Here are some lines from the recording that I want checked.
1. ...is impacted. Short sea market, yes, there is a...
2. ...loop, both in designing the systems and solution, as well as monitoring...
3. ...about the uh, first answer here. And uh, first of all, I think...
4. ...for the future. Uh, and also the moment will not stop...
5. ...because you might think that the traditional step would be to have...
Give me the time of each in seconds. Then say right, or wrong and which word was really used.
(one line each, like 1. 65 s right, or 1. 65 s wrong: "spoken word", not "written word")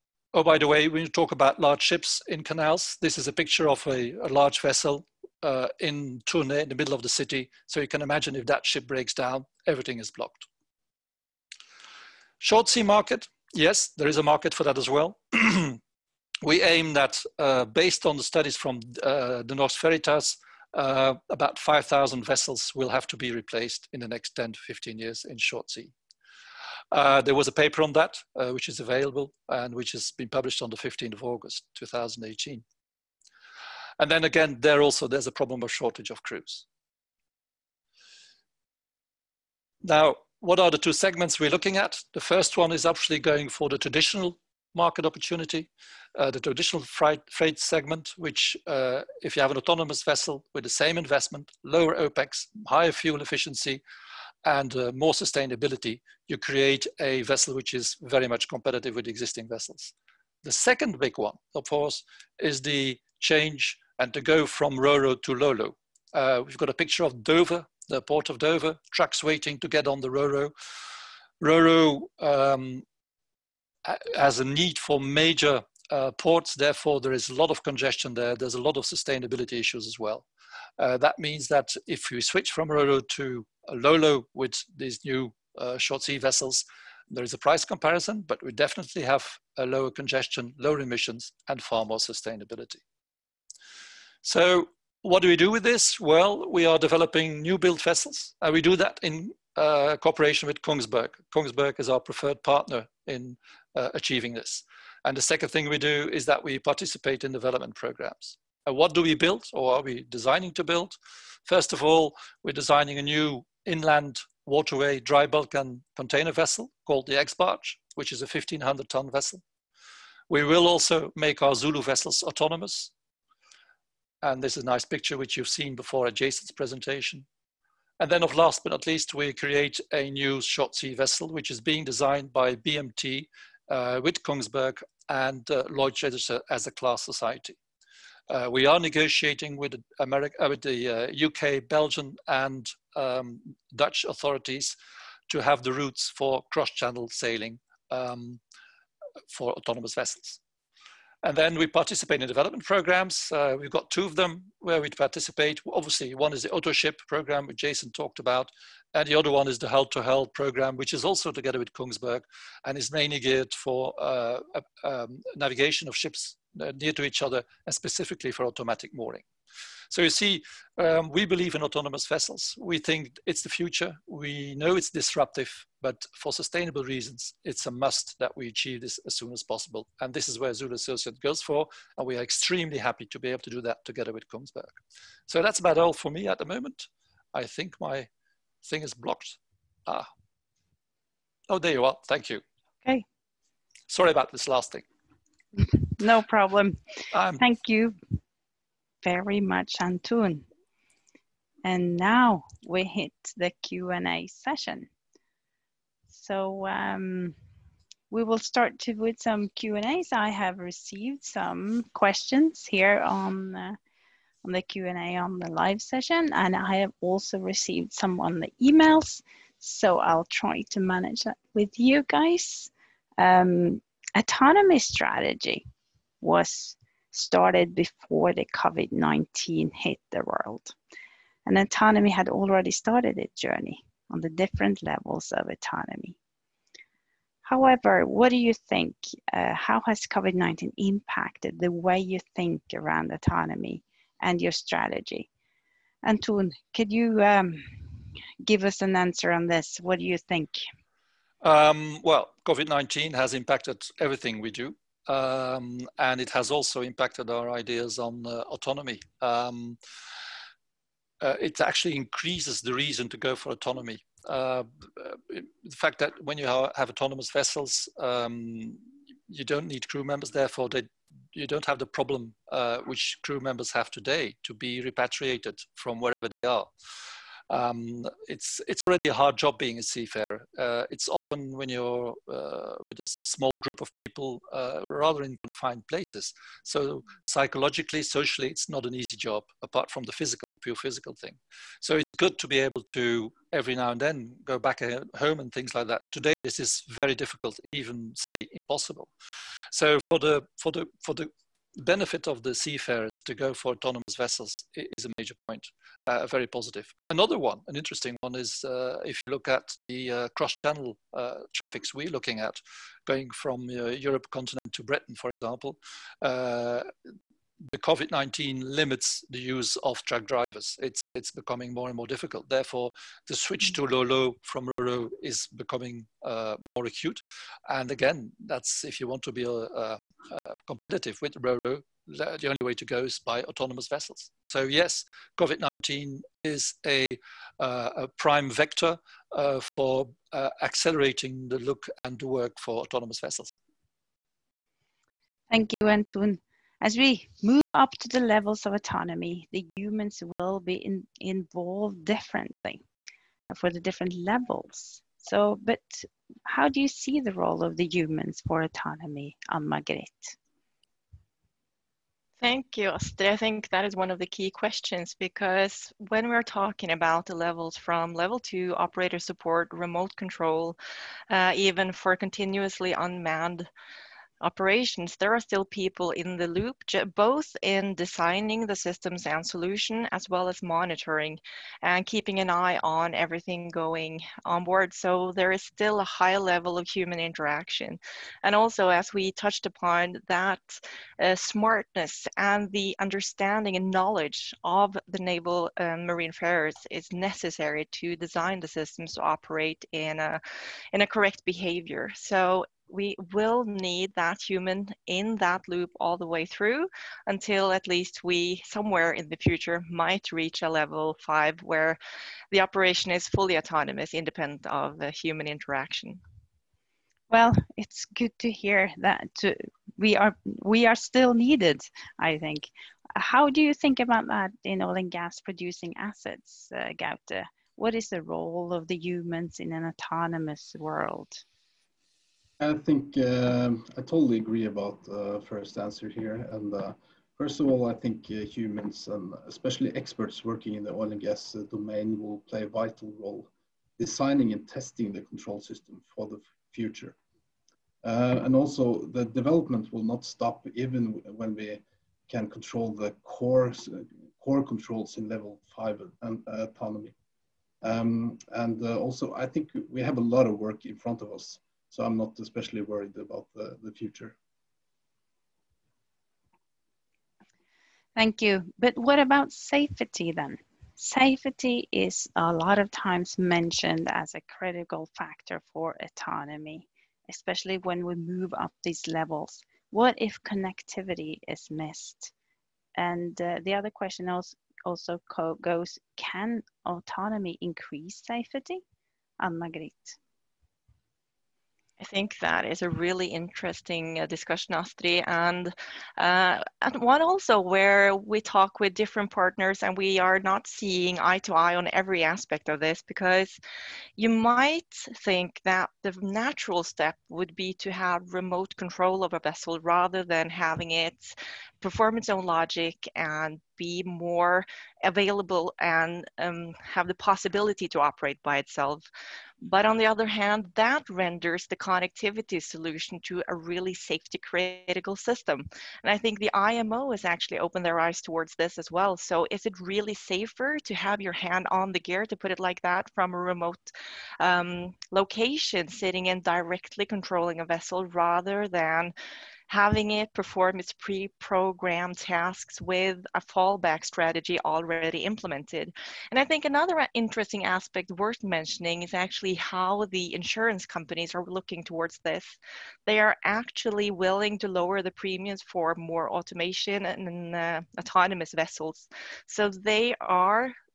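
1. 9 s wrong: "blocked", not "impacted"
2. 376 s right
3. 434 s right
4. 446 s wrong: "development", not "moment"
5. 503 s wrong: "natural", not "traditional".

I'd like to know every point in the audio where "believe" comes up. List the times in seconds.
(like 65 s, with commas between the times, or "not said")
171 s.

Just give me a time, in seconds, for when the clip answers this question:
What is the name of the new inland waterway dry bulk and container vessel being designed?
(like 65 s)
117 s.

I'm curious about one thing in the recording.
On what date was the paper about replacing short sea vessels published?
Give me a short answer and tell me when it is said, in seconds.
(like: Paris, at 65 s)
15 August 2018, at 30 s.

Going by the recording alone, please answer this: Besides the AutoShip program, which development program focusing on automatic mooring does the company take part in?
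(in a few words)
Hull to Hull.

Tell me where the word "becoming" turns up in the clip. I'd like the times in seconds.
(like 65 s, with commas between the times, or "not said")
321 s, 325 s.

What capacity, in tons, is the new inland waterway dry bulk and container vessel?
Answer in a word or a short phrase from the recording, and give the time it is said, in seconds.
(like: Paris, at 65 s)
1,500 tons, at 118 s.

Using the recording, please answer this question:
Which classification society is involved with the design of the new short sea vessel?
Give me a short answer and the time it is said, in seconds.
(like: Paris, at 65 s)
Lloyd's Register, at 135 s.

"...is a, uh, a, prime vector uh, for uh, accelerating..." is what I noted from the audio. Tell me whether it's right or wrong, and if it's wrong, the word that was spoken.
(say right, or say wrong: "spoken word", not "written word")
right.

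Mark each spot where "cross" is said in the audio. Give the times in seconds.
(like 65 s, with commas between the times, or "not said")
146 s, 310 s.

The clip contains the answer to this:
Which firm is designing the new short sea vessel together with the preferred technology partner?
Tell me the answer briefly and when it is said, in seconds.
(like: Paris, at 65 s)
BMT, at 132 s.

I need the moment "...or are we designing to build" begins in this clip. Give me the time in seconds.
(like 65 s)
109 s.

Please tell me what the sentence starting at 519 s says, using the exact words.
But on the other hand, that renders the connectivity solution to a really safety critical system.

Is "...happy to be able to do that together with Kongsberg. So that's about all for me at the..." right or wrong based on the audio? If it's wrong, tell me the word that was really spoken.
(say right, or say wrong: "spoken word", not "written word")
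right.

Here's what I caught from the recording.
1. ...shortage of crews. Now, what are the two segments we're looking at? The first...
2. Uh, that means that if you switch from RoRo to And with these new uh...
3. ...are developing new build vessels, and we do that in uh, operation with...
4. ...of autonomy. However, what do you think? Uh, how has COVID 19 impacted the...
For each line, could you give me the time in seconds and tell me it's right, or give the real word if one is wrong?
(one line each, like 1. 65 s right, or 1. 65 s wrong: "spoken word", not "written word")
1. 35 s right
2. 80 s wrong: "Lolo", not "And"
3. 96 s wrong: "cooperation", not "operation"
4. 235 s right.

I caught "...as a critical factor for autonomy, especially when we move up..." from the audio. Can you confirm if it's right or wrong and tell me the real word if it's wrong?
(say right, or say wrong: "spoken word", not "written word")
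right.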